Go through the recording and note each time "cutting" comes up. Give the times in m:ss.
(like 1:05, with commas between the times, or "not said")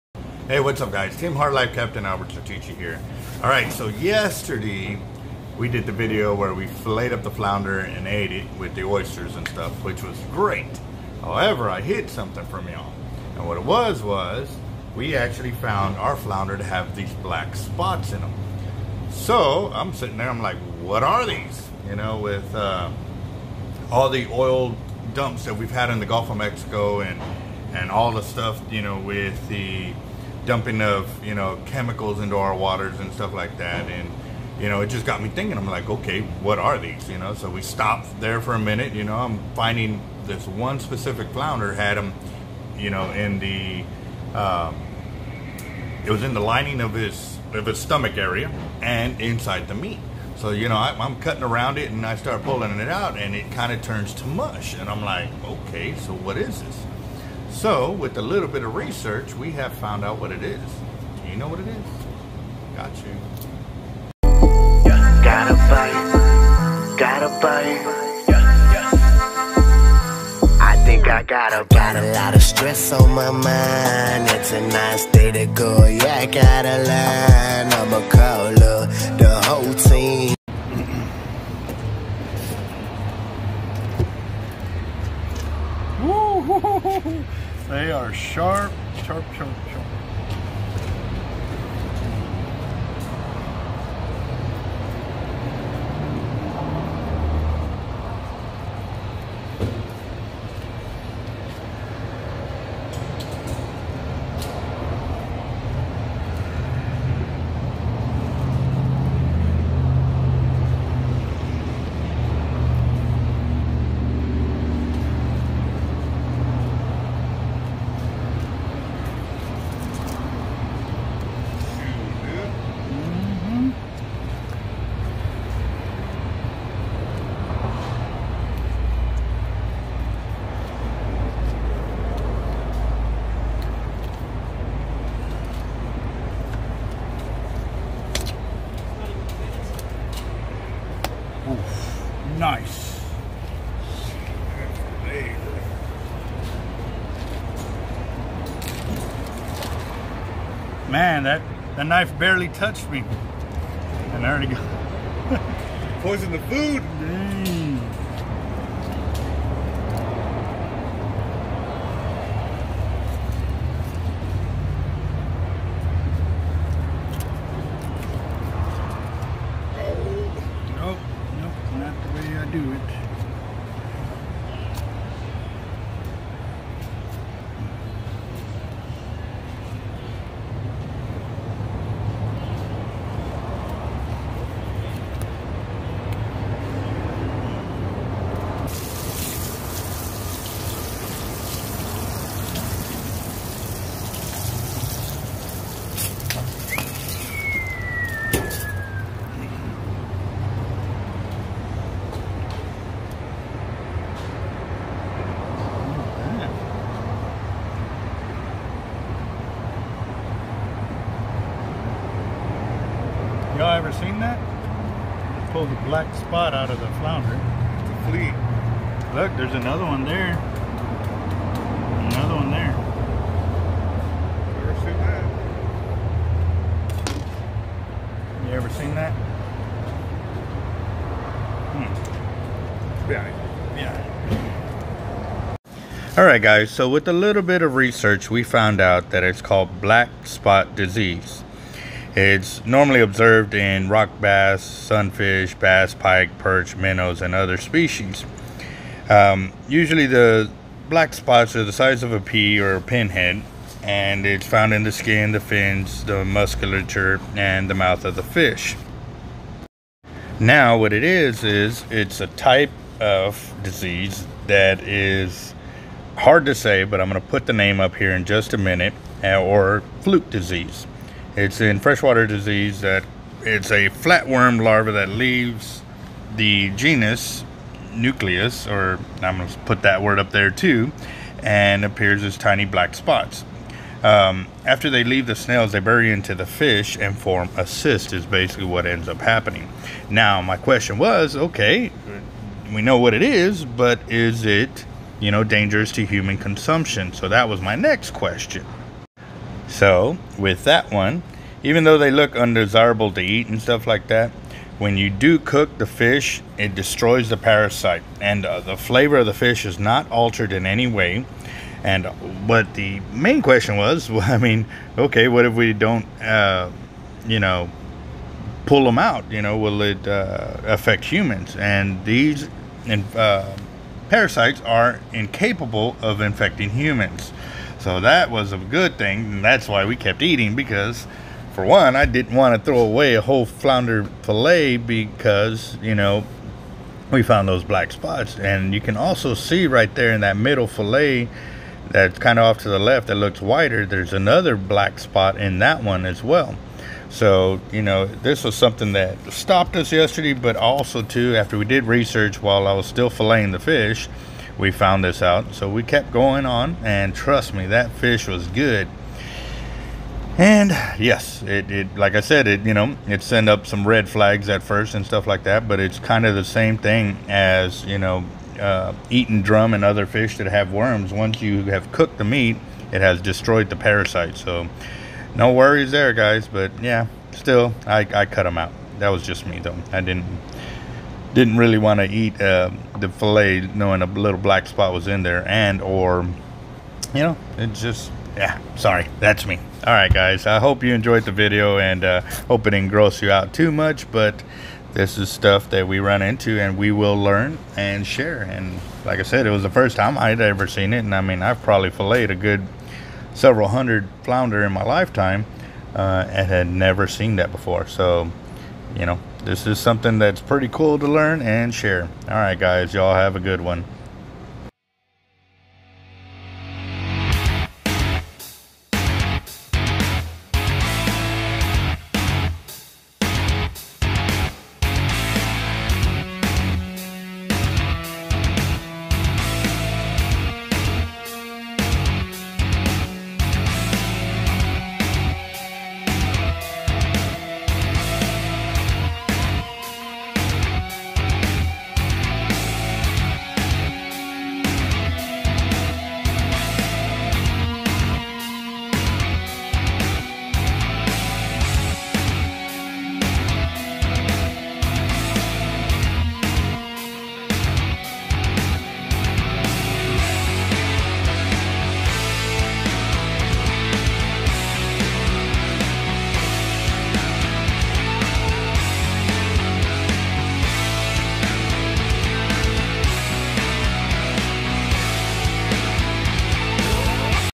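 0:51.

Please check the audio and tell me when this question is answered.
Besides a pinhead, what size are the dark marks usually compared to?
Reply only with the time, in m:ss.
4:11.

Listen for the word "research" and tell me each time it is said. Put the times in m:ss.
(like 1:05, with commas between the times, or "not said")
0:58, 3:57, 5:51.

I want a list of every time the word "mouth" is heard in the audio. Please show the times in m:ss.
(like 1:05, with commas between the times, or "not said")
4:17.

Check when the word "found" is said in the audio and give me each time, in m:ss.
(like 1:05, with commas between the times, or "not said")
0:15, 0:59, 3:58, 4:14, 5:37, 5:54.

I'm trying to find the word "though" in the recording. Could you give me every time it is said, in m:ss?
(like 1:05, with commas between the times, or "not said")
5:01, 6:19.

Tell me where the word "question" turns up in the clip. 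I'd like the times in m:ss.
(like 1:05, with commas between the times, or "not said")
4:50, 4:58, 5:13.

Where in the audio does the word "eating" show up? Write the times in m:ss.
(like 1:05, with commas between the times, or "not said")
5:30, 6:09.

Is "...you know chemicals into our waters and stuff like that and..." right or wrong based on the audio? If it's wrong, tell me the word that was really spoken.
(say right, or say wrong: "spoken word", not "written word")
right.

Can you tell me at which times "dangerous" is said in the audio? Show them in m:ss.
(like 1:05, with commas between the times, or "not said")
4:55.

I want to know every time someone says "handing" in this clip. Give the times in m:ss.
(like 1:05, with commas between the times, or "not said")
not said.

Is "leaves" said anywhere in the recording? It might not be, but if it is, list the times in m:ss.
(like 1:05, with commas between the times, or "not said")
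4:35, 4:45.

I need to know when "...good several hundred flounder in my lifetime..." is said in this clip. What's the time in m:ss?
6:42.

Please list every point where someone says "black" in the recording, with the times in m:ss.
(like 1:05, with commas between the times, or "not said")
0:17, 3:35, 3:59, 4:10, 4:42, 5:37, 5:44, 6:24.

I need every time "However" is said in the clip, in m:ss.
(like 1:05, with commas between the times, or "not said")
0:11.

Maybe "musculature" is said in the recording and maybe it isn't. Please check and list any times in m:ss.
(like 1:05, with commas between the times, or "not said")
4:16.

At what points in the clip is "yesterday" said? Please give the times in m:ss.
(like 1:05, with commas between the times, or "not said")
0:03, 5:49.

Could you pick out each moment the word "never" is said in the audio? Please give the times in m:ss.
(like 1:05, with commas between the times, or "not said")
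6:46.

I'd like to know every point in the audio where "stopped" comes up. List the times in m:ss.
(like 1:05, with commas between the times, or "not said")
0:37, 5:49.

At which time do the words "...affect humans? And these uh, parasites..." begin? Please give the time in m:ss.
5:20.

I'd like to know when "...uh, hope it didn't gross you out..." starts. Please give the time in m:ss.
6:32.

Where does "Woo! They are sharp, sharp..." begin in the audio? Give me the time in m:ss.
1:27.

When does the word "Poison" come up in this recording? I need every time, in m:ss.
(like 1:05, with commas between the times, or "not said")
2:36.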